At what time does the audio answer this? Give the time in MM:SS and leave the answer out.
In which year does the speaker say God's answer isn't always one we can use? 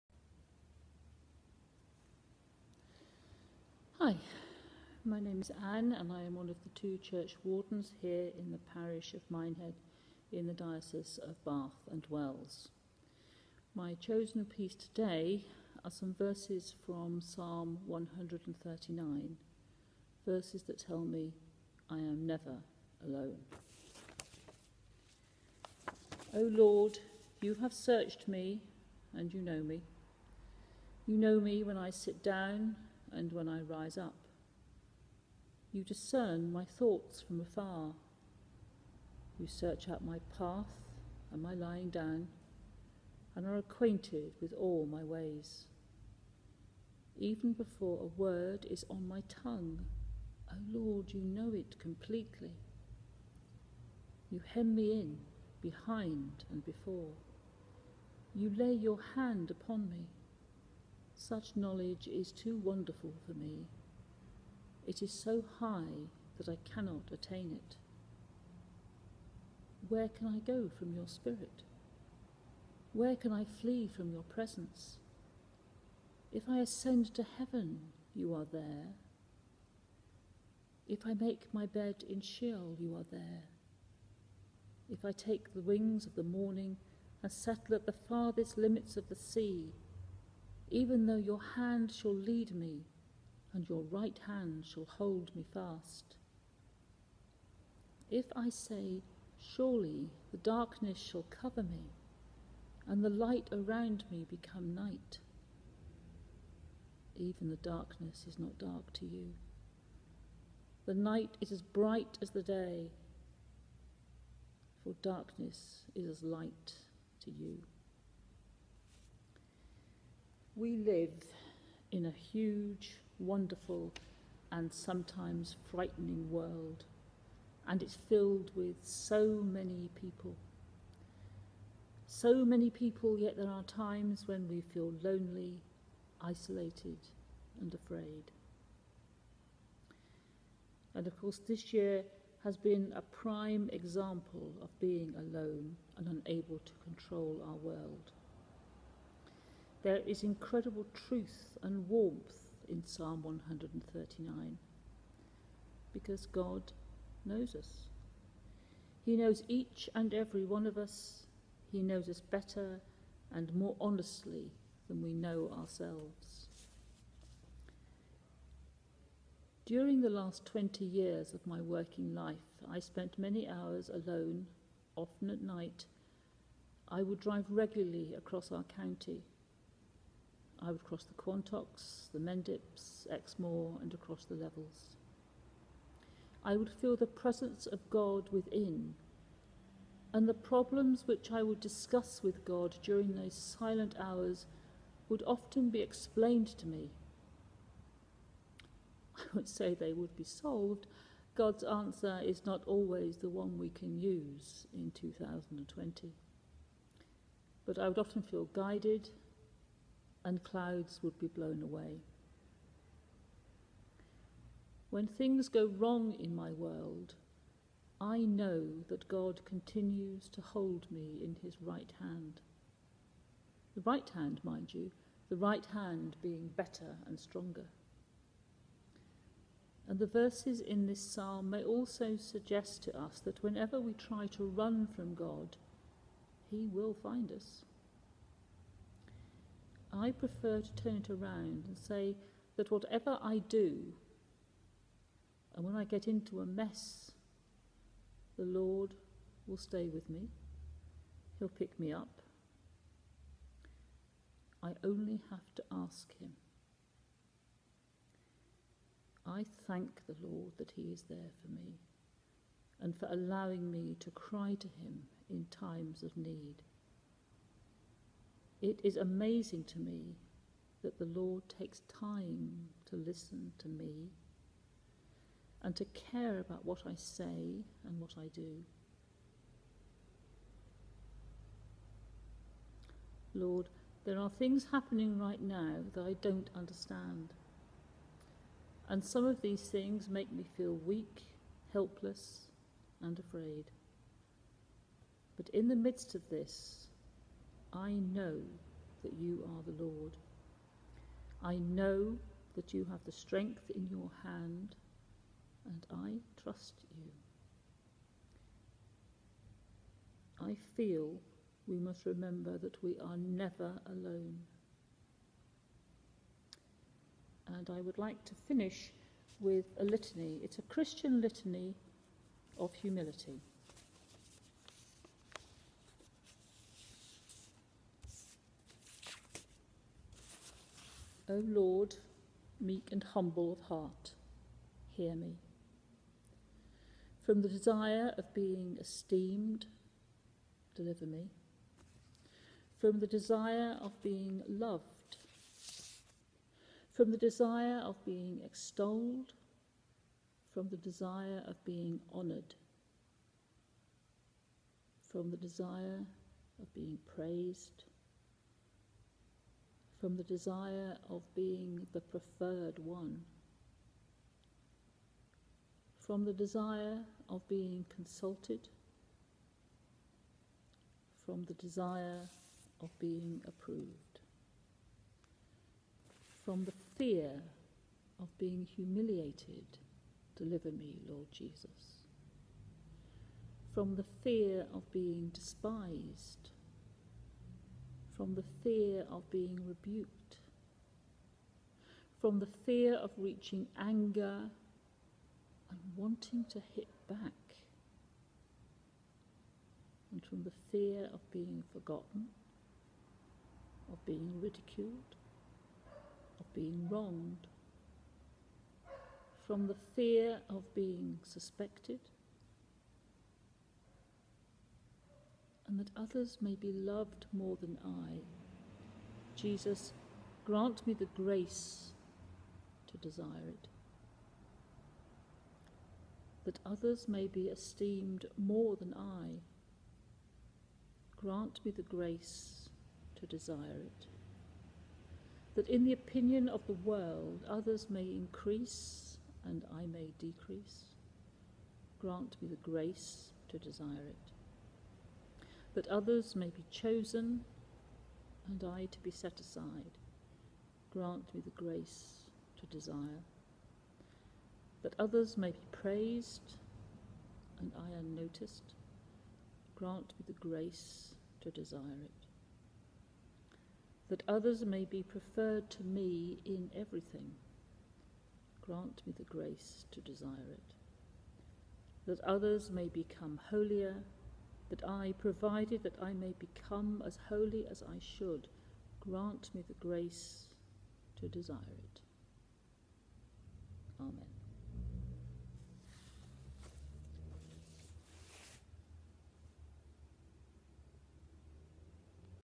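03:24.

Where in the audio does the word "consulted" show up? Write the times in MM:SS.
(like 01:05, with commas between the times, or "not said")
06:07.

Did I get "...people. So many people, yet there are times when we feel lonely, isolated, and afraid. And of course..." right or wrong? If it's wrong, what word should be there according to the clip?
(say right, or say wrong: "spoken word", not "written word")
right.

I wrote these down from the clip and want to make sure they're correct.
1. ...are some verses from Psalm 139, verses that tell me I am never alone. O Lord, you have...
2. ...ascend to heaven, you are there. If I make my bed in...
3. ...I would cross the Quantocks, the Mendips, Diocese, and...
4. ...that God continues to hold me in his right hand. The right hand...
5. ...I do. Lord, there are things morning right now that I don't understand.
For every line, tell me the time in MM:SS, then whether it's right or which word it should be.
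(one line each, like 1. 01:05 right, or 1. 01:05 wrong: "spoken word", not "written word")
1. 00:15 right
2. 01:16 right
3. 03:00 wrong: "Exmoor", not "Diocese"
4. 03:38 right
5. 04:38 wrong: "happening", not "morning".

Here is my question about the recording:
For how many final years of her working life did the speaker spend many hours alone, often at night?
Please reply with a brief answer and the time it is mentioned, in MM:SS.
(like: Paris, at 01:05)
20, at 02:50.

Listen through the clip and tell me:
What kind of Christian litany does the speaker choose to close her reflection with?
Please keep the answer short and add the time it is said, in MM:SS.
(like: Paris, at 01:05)
humility, at 05:22.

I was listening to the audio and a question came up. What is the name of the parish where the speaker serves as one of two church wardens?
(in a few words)
Minehead.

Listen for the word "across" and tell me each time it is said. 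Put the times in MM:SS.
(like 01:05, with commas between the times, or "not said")
02:58, 03:03.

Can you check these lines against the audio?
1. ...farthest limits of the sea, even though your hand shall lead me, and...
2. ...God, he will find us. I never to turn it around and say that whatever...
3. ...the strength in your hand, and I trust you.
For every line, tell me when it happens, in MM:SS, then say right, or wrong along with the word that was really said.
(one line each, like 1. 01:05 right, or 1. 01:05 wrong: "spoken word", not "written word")
1. 01:28 right
2. 03:55 wrong: "prefer", not "never"
3. 05:03 right.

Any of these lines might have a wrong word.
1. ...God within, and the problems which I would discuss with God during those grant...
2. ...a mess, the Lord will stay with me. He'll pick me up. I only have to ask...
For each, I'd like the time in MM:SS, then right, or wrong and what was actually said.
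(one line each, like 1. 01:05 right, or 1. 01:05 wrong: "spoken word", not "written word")
1. 03:07 wrong: "silent", not "grant"
2. 04:06 right.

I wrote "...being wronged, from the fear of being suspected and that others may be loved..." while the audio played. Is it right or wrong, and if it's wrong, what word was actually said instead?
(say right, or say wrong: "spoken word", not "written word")
right.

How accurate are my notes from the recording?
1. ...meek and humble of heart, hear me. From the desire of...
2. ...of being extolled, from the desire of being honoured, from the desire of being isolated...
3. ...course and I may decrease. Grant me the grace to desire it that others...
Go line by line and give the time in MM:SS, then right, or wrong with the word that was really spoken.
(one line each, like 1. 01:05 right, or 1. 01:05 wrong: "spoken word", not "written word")
1. 05:32 right
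2. 05:47 wrong: "praised", not "isolated"
3. 07:18 wrong: "increase", not "course".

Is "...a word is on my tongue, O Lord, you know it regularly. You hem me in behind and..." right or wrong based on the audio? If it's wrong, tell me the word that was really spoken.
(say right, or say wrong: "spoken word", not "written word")
wrong: "completely", not "regularly".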